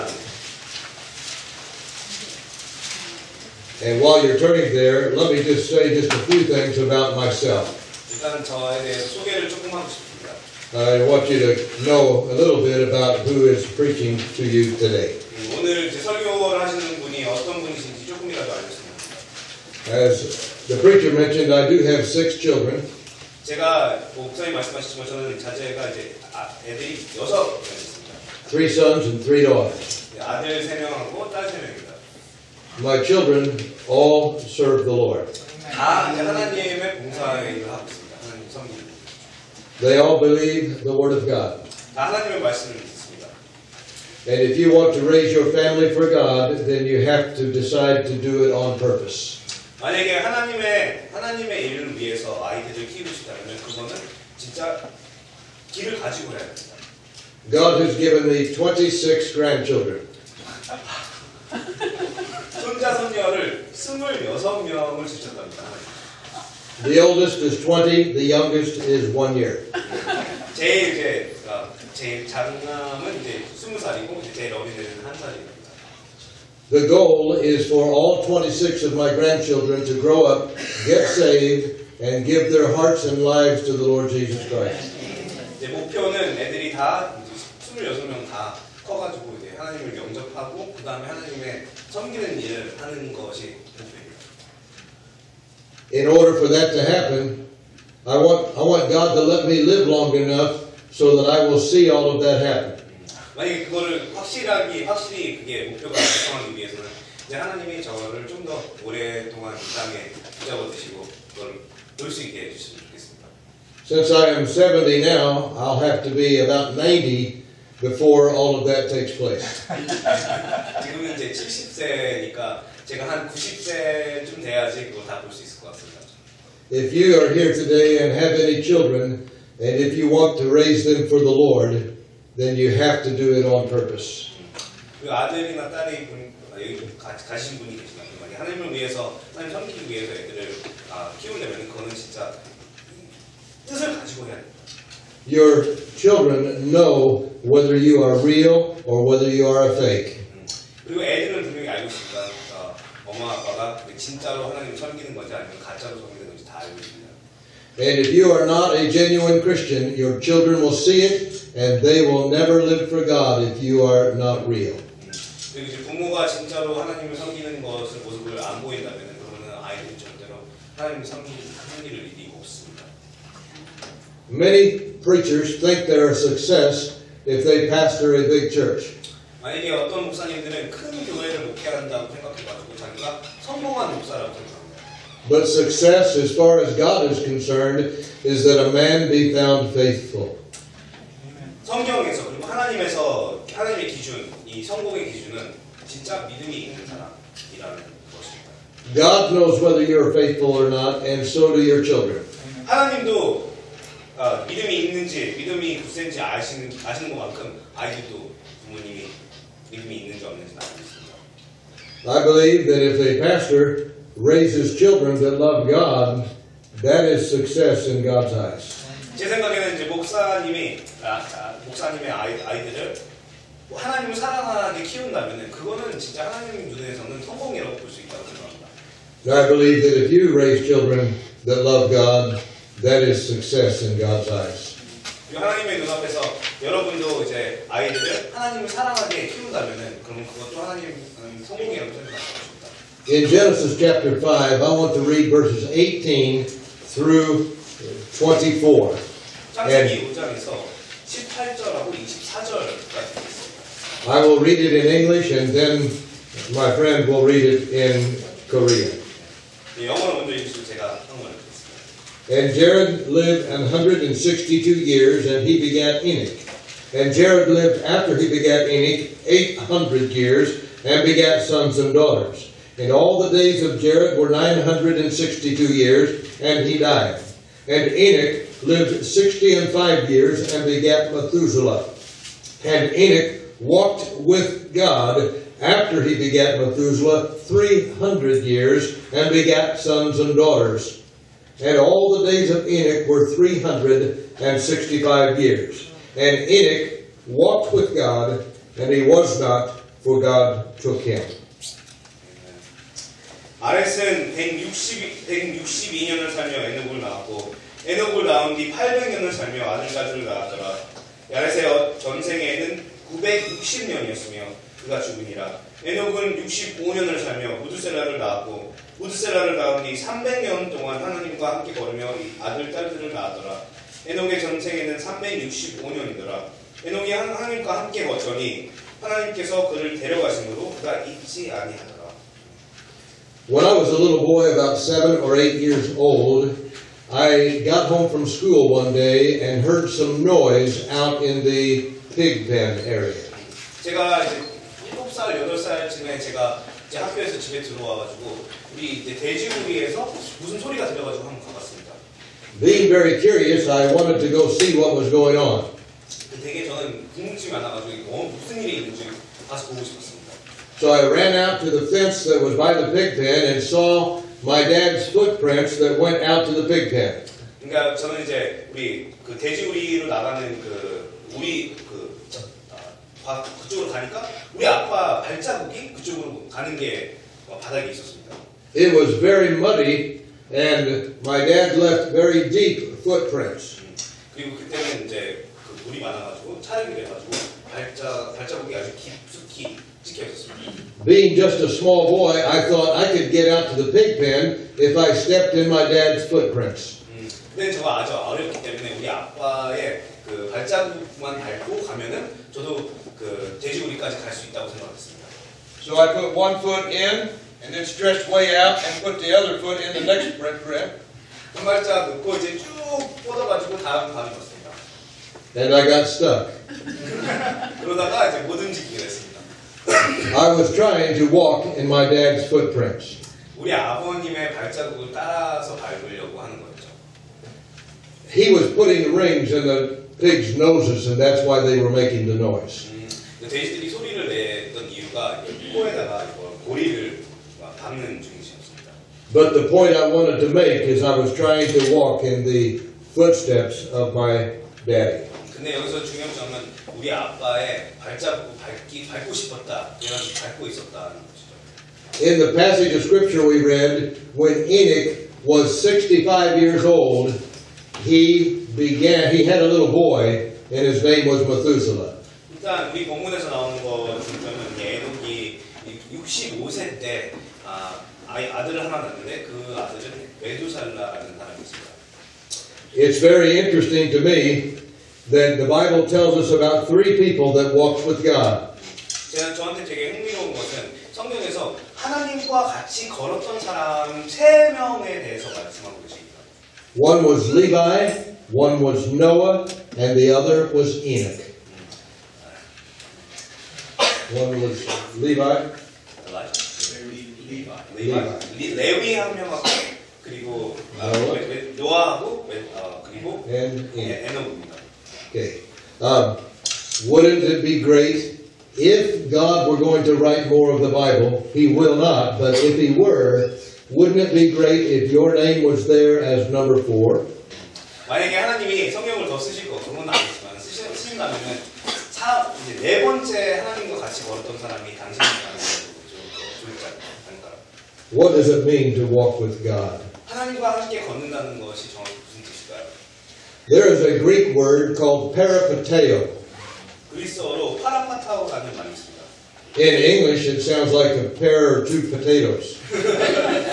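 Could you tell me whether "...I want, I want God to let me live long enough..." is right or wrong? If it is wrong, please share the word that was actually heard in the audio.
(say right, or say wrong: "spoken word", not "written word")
right.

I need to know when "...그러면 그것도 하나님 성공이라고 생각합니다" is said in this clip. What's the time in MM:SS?
04:00.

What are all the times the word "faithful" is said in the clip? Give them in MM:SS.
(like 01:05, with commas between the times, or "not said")
03:09, 03:20.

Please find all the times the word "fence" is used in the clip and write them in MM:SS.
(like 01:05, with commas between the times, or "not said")
06:01.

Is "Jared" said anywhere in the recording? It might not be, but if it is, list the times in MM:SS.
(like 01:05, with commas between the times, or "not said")
04:22, 04:27, 04:33.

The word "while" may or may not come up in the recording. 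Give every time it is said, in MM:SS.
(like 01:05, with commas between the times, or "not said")
00:04.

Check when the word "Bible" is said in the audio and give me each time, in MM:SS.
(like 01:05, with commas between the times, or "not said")
07:55, 08:30.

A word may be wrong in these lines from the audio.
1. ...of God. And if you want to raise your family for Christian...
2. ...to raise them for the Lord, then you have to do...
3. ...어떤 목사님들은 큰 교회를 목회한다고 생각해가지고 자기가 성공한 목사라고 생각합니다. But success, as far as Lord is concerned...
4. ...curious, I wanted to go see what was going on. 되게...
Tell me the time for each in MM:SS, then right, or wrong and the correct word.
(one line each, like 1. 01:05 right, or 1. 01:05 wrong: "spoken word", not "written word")
1. 00:41 wrong: "God", not "Christian"
2. 02:10 right
3. 02:59 wrong: "God", not "Lord"
4. 05:53 right.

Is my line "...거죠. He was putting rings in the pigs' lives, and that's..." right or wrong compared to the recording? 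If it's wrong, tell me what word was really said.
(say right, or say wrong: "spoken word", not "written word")
wrong: "noses", not "lives".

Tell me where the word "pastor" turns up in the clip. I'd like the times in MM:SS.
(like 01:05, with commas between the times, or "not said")
02:57, 03:33.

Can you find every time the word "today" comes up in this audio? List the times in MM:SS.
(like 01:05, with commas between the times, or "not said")
00:14, 02:07.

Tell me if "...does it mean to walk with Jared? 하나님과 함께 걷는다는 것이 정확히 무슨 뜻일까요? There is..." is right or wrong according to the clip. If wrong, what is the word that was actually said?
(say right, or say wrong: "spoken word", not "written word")
wrong: "God", not "Jared".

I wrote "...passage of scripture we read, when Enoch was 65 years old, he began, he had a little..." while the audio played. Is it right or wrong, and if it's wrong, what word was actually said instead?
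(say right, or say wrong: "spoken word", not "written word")
right.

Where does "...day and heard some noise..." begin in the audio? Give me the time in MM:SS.
05:38.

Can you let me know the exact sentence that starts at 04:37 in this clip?
And Enoch lived 60 and 5 years, and begat Methuselah.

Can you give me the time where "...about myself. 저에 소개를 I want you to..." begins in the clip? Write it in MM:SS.
00:06.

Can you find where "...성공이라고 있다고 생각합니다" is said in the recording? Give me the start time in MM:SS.
03:47.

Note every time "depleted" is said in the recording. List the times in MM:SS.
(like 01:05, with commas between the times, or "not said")
not said.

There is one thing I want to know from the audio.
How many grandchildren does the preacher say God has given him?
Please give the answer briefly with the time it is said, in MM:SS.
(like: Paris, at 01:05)
26, at 00:58.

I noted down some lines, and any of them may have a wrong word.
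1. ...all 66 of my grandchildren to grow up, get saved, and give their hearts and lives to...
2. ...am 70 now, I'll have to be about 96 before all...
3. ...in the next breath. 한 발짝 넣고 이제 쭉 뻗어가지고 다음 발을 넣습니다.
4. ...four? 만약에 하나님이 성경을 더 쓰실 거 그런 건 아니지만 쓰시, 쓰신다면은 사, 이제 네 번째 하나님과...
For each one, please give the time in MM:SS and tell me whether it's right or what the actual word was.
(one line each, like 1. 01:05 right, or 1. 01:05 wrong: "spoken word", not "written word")
1. 01:17 wrong: "26", not "66"
2. 01:54 wrong: "90", not "96"
3. 06:49 right
4. 08:36 right.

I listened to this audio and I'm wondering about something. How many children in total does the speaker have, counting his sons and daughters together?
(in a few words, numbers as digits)
6.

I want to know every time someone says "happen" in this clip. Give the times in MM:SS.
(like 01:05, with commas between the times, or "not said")
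01:36, 01:42.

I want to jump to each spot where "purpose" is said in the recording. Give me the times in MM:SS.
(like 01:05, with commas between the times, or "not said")
00:48, 02:13.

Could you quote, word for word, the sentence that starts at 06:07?
그러니까 저는 이제 우리 그 돼지우리로 나가는 그 우리 그 그쪽으로 가니까 우리 아빠 발자국이 그쪽으로 가는 게 바닥에 있었습니다.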